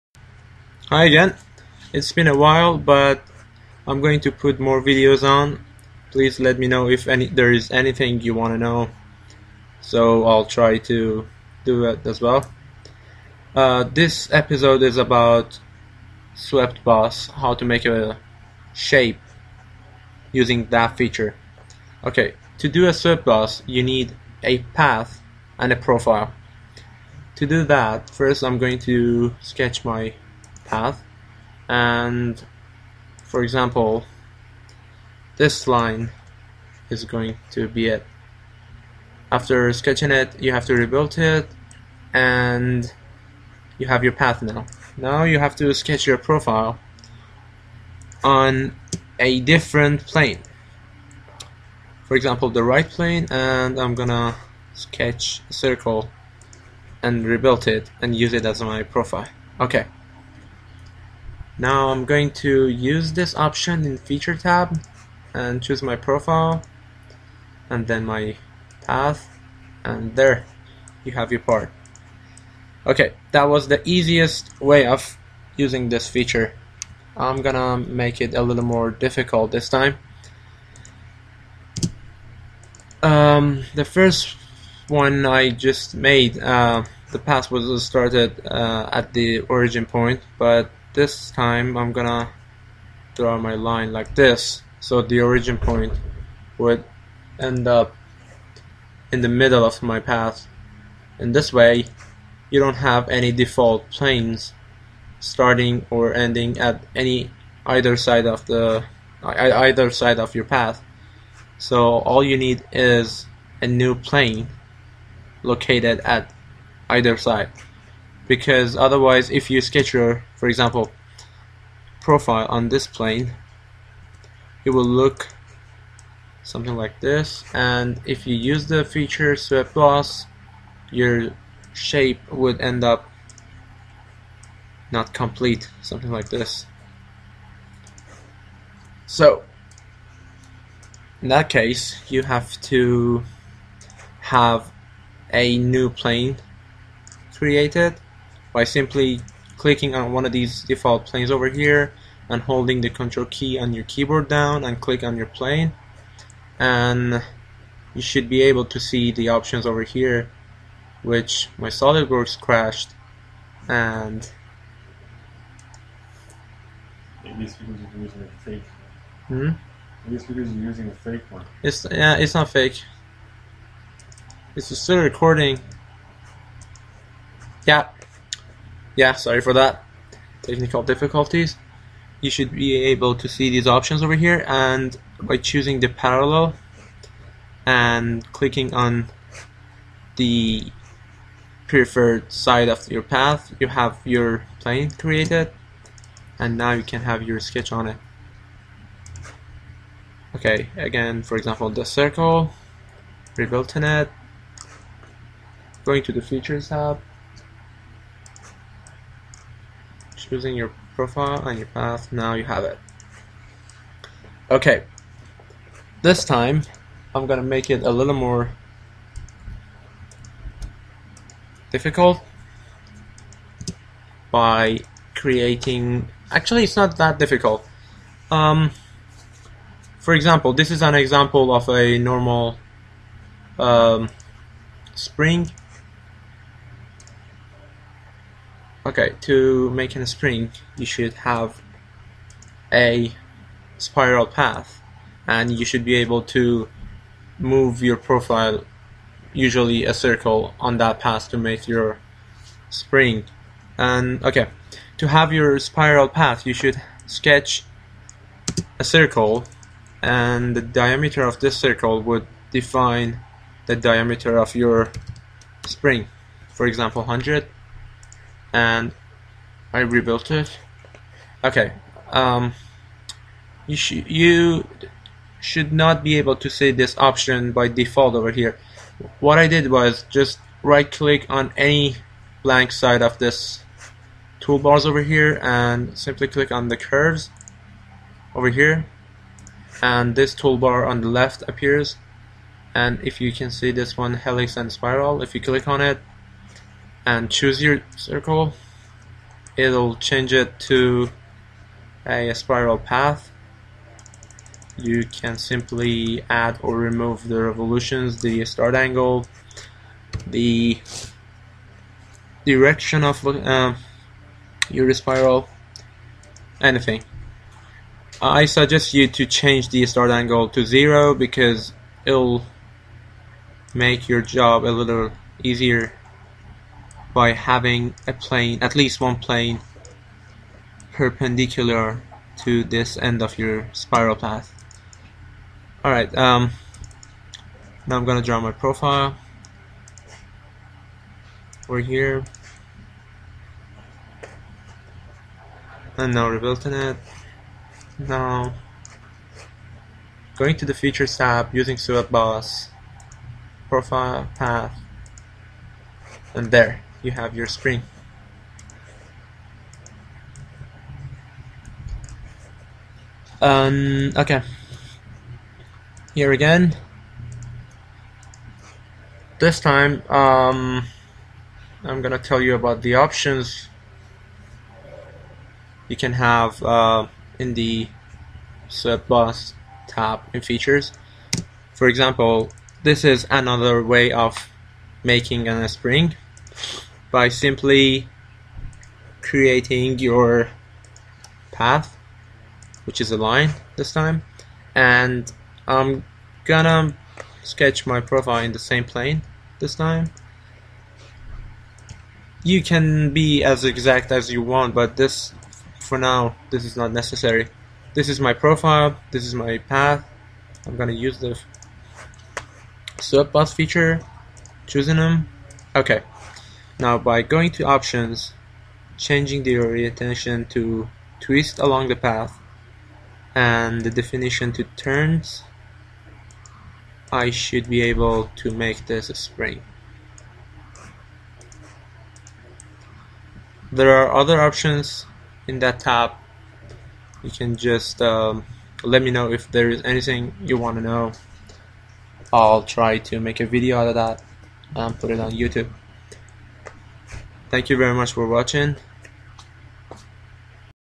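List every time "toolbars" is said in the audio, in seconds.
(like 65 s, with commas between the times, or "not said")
284 s, 290 s.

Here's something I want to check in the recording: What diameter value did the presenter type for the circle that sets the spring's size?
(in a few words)
100.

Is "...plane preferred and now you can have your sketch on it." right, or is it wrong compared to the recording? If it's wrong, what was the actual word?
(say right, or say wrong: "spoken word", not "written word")
wrong: "created", not "preferred".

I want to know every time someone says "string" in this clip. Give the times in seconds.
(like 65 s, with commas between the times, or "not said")
357 s.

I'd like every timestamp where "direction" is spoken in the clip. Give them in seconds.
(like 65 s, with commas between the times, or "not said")
312 s.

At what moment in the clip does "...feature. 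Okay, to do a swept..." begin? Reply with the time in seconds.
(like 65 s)
20 s.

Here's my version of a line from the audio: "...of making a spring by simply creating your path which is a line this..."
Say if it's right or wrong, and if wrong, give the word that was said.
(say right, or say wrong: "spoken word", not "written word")
right.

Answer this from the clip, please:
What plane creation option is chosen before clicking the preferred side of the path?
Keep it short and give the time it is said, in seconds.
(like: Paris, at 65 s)
Parallel, at 185 s.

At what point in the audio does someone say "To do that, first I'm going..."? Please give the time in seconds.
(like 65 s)
27 s.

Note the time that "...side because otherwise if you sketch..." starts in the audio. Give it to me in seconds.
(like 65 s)
117 s.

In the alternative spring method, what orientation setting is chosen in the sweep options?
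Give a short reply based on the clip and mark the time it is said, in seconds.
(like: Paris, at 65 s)
Twist along the path, at 421 s.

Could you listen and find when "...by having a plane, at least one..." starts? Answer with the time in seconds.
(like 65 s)
327 s.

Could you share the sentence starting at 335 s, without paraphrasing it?
Alright, um, now I'm gonna draw my profile.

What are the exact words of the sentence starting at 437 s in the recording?
You can just um, let me know if there is anything you want to know.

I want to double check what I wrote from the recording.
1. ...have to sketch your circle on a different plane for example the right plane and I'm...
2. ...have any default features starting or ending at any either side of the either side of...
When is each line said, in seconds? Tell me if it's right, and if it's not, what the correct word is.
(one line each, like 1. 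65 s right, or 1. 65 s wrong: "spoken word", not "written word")
1. 45 s wrong: "profile", not "circle"
2. 102 s wrong: "planes", not "features".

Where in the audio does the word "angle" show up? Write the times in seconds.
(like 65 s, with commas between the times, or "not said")
308 s, 320 s.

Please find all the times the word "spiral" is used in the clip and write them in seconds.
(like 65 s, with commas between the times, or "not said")
243 s, 255 s, 294 s, 302 s, 314 s, 333 s.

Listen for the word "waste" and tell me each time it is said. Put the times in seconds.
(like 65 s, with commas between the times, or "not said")
not said.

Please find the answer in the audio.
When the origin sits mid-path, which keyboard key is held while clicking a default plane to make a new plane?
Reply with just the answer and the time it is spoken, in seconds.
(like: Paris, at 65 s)
Control, at 152 s.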